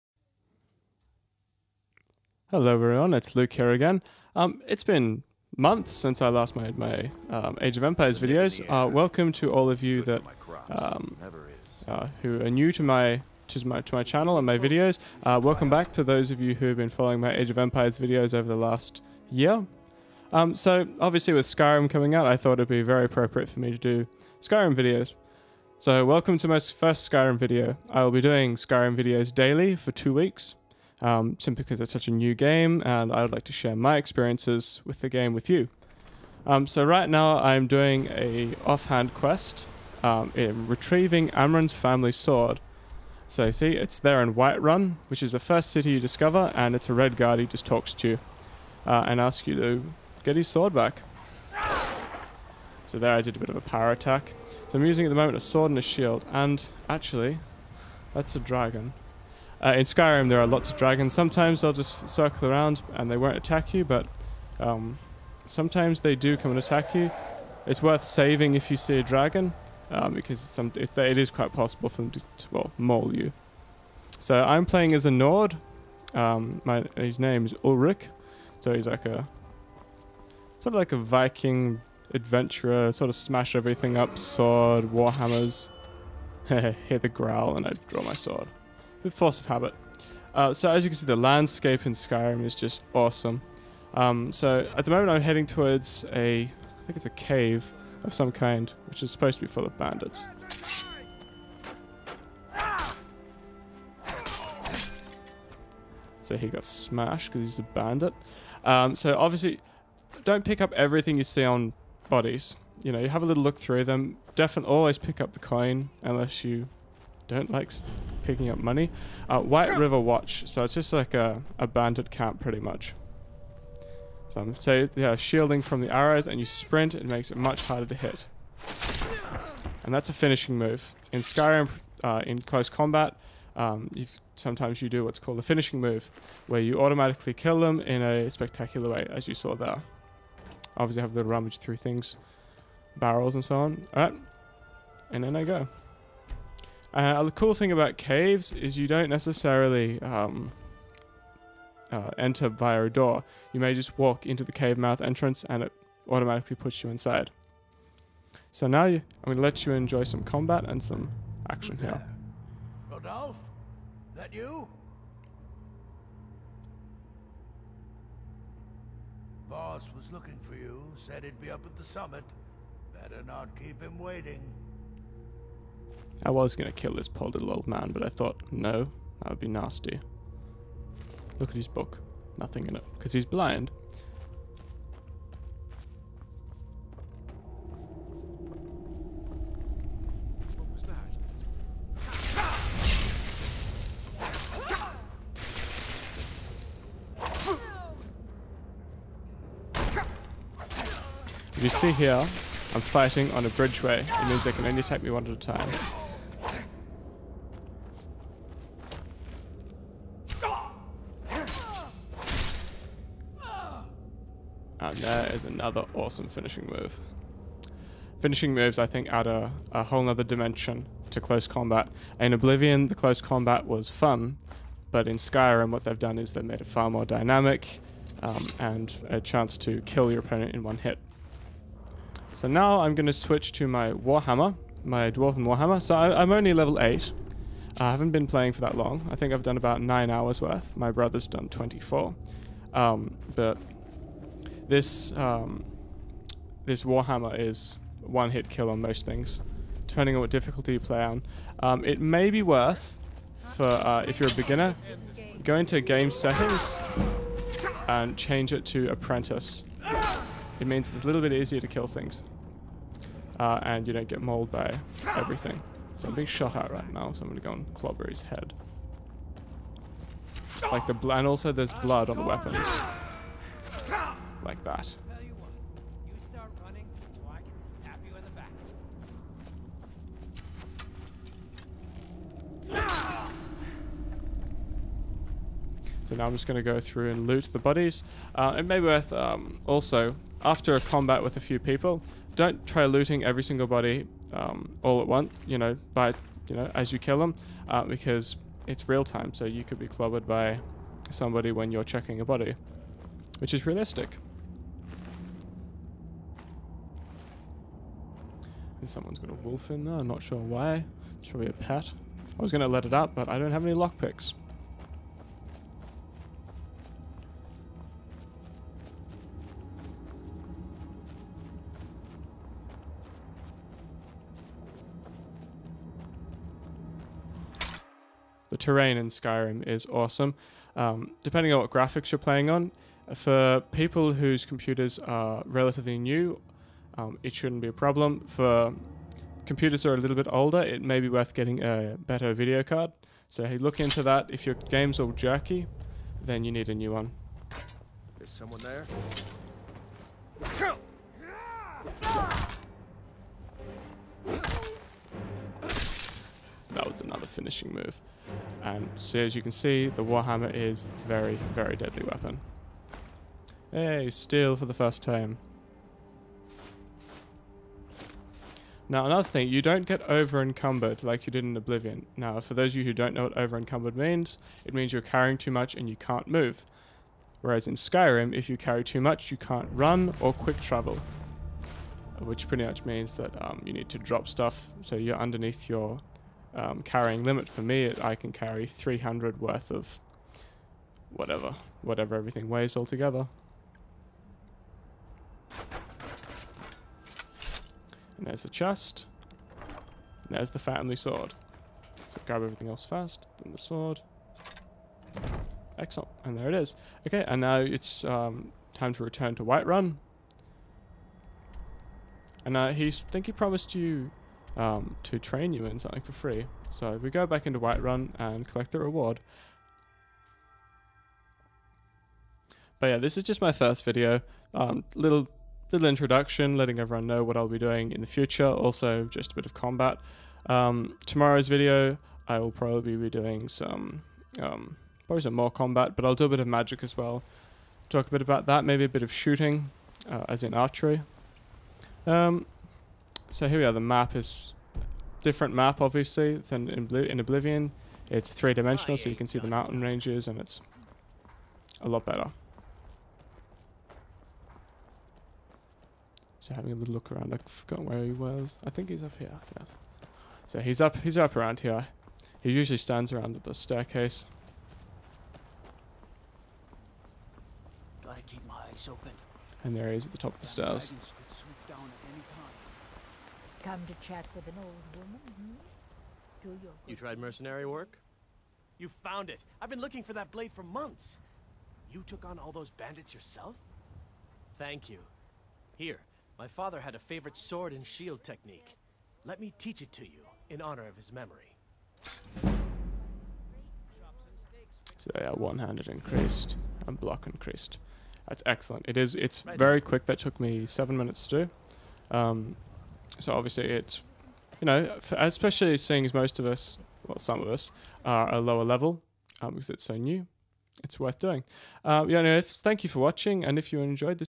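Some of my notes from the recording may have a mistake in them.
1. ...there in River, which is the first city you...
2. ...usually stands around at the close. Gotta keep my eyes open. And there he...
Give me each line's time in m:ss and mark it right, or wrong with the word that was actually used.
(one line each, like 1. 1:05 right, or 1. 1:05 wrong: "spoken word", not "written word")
1. 0:43 wrong: "Whiterun", not "River"
2. 7:42 wrong: "staircase", not "close".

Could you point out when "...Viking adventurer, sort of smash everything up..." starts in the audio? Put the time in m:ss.
1:20.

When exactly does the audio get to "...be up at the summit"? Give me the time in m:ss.
2:51.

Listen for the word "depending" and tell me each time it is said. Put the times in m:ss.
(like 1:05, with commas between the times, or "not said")
4:09, 5:31.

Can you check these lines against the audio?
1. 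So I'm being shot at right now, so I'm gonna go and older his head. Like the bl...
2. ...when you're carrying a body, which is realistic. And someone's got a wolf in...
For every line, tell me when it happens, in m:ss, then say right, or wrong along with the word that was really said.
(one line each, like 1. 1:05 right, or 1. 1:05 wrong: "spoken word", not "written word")
1. 4:25 wrong: "clobber", not "older"
2. 5:01 wrong: "checking", not "carrying".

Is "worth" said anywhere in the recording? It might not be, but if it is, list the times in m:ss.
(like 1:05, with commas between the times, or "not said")
1:07, 4:00, 4:12, 4:48, 5:41, 6:29, 8:30.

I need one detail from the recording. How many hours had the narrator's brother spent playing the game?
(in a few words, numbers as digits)
24.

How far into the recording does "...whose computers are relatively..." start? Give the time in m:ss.
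5:34.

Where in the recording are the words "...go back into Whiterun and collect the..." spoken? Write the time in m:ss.
6:57.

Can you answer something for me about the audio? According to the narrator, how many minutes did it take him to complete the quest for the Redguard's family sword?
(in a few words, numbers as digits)
7.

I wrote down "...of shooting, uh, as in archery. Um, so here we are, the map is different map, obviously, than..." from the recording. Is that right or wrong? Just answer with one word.
right.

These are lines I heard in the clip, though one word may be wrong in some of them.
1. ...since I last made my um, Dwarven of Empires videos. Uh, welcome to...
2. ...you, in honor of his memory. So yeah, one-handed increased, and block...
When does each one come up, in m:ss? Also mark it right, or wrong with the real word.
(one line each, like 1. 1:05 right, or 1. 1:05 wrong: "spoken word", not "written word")
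1. 0:05 wrong: "Age", not "Dwarven"
2. 8:10 right.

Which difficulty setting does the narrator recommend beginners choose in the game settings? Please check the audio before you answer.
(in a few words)
Apprentice.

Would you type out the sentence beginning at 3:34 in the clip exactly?
And there is another awesome finishing move.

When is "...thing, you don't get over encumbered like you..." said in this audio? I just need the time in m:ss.
6:09.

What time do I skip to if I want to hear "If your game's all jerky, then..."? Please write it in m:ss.
5:44.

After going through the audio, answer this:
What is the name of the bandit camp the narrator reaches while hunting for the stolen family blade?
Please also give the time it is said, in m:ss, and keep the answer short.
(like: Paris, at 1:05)
White River Watch, at 1:59.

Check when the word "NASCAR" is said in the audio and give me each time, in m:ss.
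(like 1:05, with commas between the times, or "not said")
not said.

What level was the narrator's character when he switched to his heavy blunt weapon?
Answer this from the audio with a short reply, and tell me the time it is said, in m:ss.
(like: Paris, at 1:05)
8, at 3:56.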